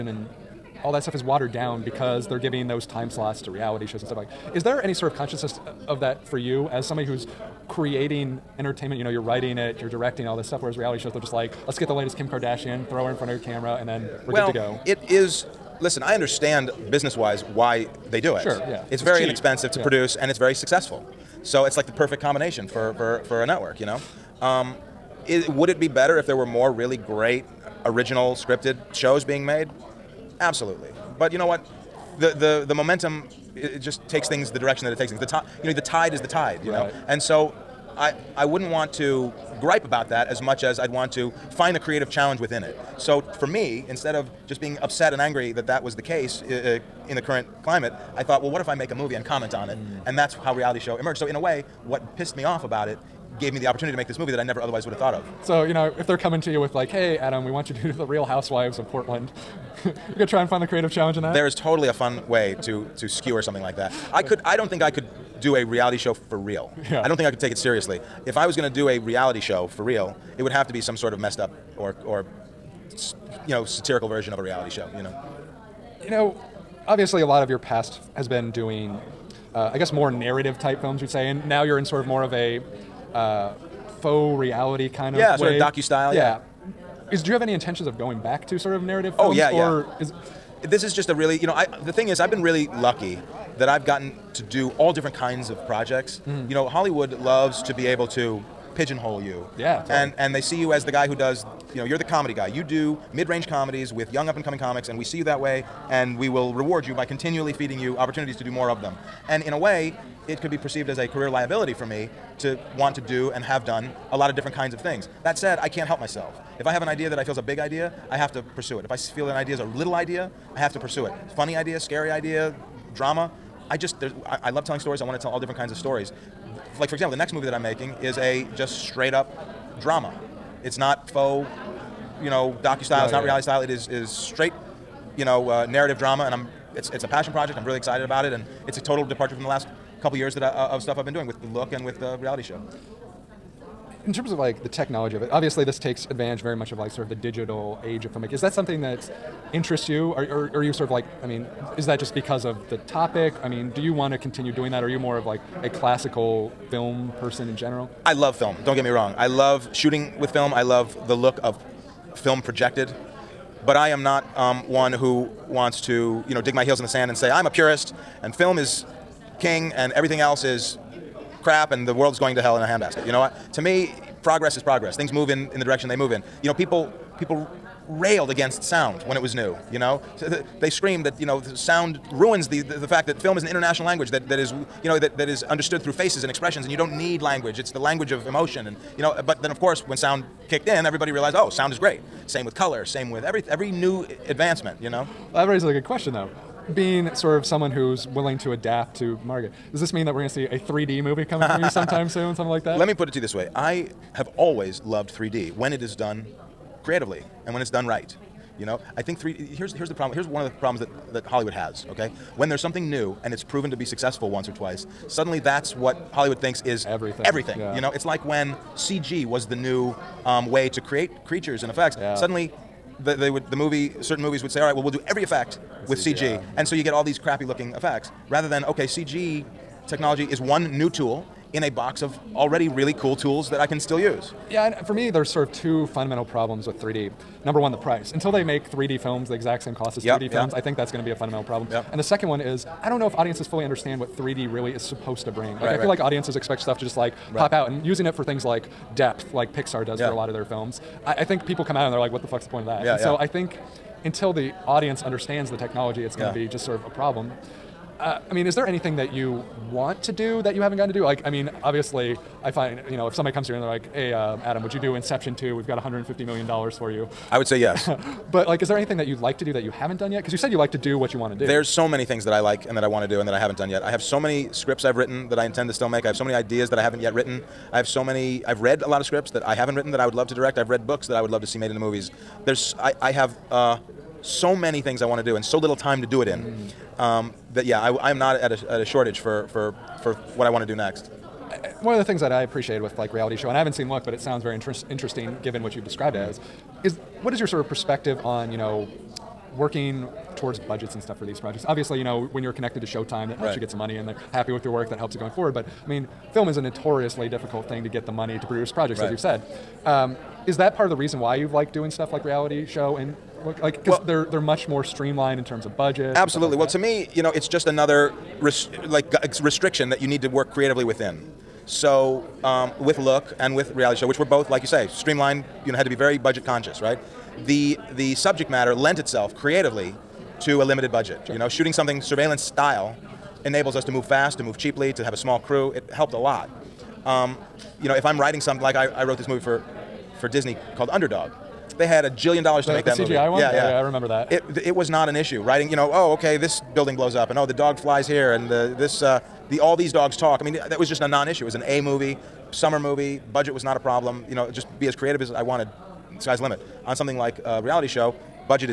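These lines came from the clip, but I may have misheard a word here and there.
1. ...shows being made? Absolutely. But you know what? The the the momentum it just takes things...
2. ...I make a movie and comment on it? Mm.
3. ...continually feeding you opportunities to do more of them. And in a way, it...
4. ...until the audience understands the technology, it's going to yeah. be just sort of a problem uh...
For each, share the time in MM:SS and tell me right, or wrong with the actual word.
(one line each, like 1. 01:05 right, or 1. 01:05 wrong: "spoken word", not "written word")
1. 00:28 right
2. 00:48 right
3. 01:47 right
4. 04:14 right.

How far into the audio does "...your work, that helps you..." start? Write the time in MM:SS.
05:04.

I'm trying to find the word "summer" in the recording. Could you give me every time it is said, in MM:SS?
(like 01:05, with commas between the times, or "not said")
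05:52.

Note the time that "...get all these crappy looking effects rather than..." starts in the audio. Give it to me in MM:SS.
03:46.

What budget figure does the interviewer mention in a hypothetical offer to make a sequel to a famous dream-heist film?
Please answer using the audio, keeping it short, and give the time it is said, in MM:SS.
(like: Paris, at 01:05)
$150 million, at 04:25.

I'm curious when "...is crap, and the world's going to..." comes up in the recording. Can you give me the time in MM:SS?
02:50.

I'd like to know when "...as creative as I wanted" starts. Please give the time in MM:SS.
05:54.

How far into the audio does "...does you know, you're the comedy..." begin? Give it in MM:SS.
01:41.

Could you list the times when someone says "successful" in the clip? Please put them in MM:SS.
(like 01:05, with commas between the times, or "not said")
00:20, 03:33.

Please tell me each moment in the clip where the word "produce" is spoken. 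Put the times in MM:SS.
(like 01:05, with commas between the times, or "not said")
00:19, 05:08.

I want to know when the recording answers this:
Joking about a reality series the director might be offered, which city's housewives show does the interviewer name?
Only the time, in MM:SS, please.
00:58.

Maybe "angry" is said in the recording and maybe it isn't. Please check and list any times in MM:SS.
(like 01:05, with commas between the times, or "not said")
00:45.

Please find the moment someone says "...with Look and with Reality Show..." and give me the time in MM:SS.
05:22.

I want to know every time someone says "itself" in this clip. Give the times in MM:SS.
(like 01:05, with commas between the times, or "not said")
05:28.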